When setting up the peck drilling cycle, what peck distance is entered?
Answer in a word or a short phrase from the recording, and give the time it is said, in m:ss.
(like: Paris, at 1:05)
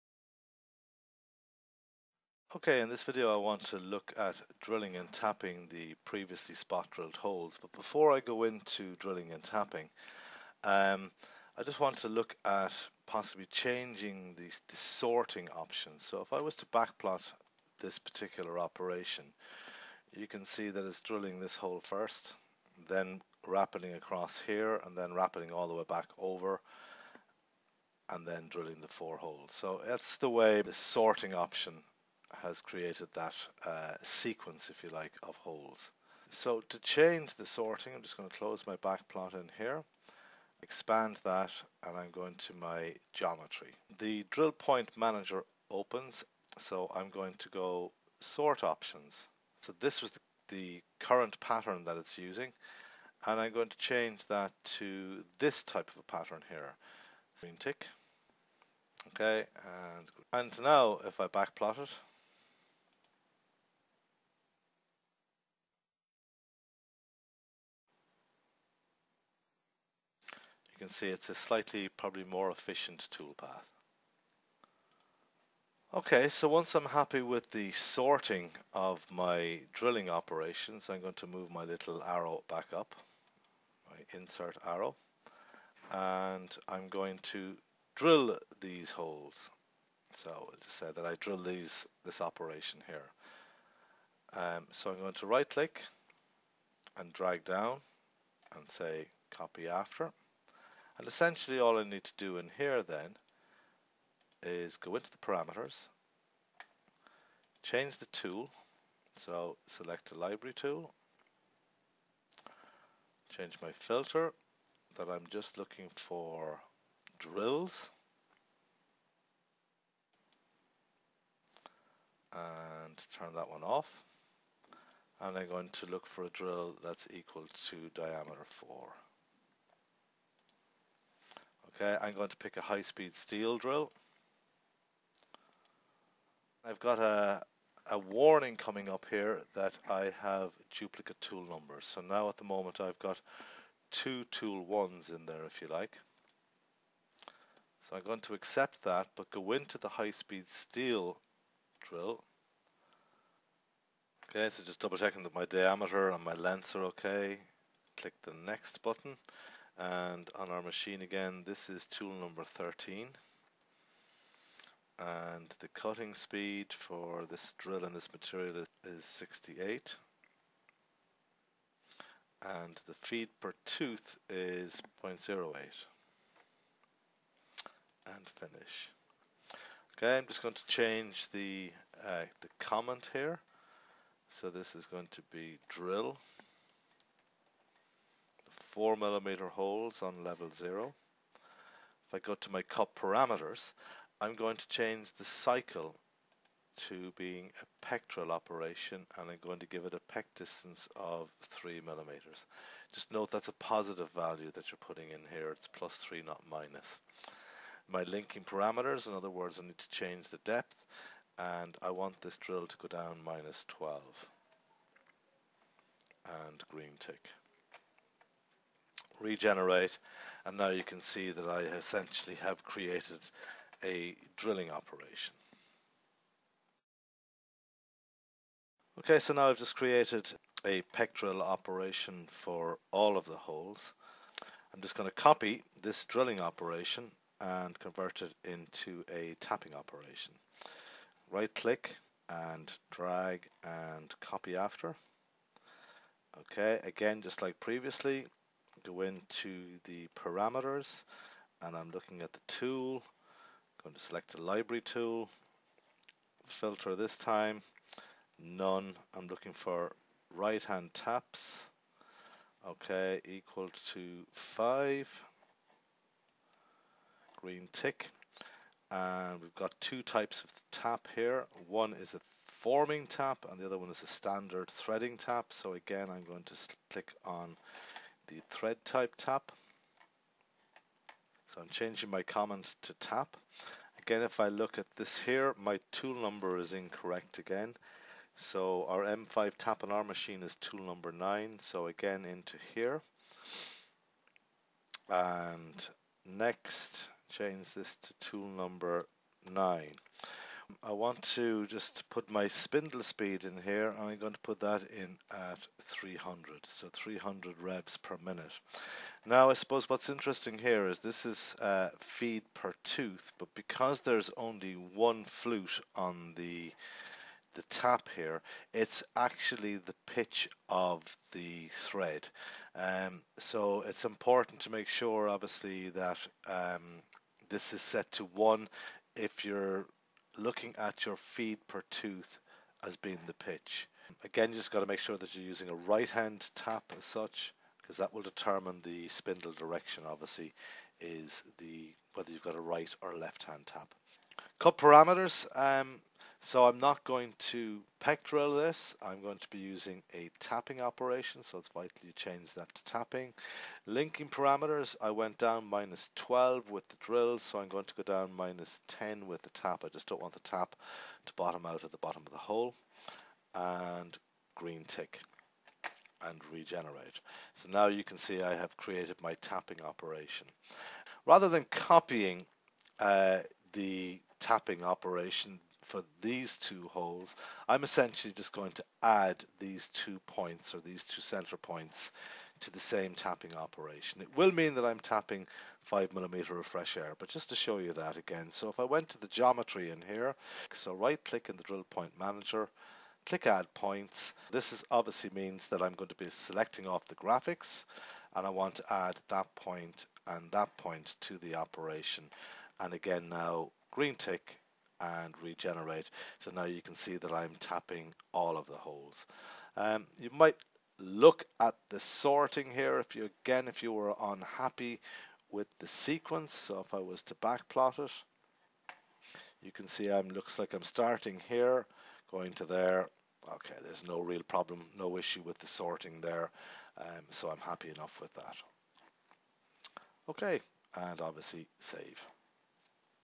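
3 millimeters, at 3:21.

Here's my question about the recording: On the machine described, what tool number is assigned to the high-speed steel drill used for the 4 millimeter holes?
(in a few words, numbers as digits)
13.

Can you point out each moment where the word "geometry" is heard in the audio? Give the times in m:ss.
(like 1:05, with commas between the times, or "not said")
0:43, 6:29.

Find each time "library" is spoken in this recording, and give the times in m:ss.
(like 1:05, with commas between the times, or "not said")
1:50, 4:14.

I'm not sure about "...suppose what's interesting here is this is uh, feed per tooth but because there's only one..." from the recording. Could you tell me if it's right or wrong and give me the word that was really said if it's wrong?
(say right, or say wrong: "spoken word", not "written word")
right.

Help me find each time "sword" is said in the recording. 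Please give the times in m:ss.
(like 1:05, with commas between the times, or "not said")
not said.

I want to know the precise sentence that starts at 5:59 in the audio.
I just don't want the tap to bottom out at the bottom of the hole.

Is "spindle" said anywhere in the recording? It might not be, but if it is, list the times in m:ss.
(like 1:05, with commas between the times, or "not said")
5:02, 5:39.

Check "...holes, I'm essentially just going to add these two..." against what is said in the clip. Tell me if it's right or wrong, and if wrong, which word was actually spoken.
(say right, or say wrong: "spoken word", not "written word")
right.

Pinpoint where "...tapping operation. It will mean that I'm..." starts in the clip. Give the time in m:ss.
6:23.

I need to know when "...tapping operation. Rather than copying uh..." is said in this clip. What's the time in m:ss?
6:09.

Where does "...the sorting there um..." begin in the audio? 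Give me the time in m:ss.
7:05.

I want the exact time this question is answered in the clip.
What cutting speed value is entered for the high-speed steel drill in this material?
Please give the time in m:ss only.
2:49.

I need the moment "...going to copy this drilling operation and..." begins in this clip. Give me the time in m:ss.
3:54.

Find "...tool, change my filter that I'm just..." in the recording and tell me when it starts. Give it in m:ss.
1:50.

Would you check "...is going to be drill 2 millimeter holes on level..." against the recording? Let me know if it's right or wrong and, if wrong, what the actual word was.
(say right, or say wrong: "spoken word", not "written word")
wrong: "4", not "2".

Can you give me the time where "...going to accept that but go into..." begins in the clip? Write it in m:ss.
2:28.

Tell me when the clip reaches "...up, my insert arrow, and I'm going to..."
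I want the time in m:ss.
1:22.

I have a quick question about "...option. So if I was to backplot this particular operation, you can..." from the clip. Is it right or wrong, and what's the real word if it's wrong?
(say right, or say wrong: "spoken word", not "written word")
right.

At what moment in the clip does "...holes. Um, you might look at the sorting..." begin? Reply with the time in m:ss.
6:48.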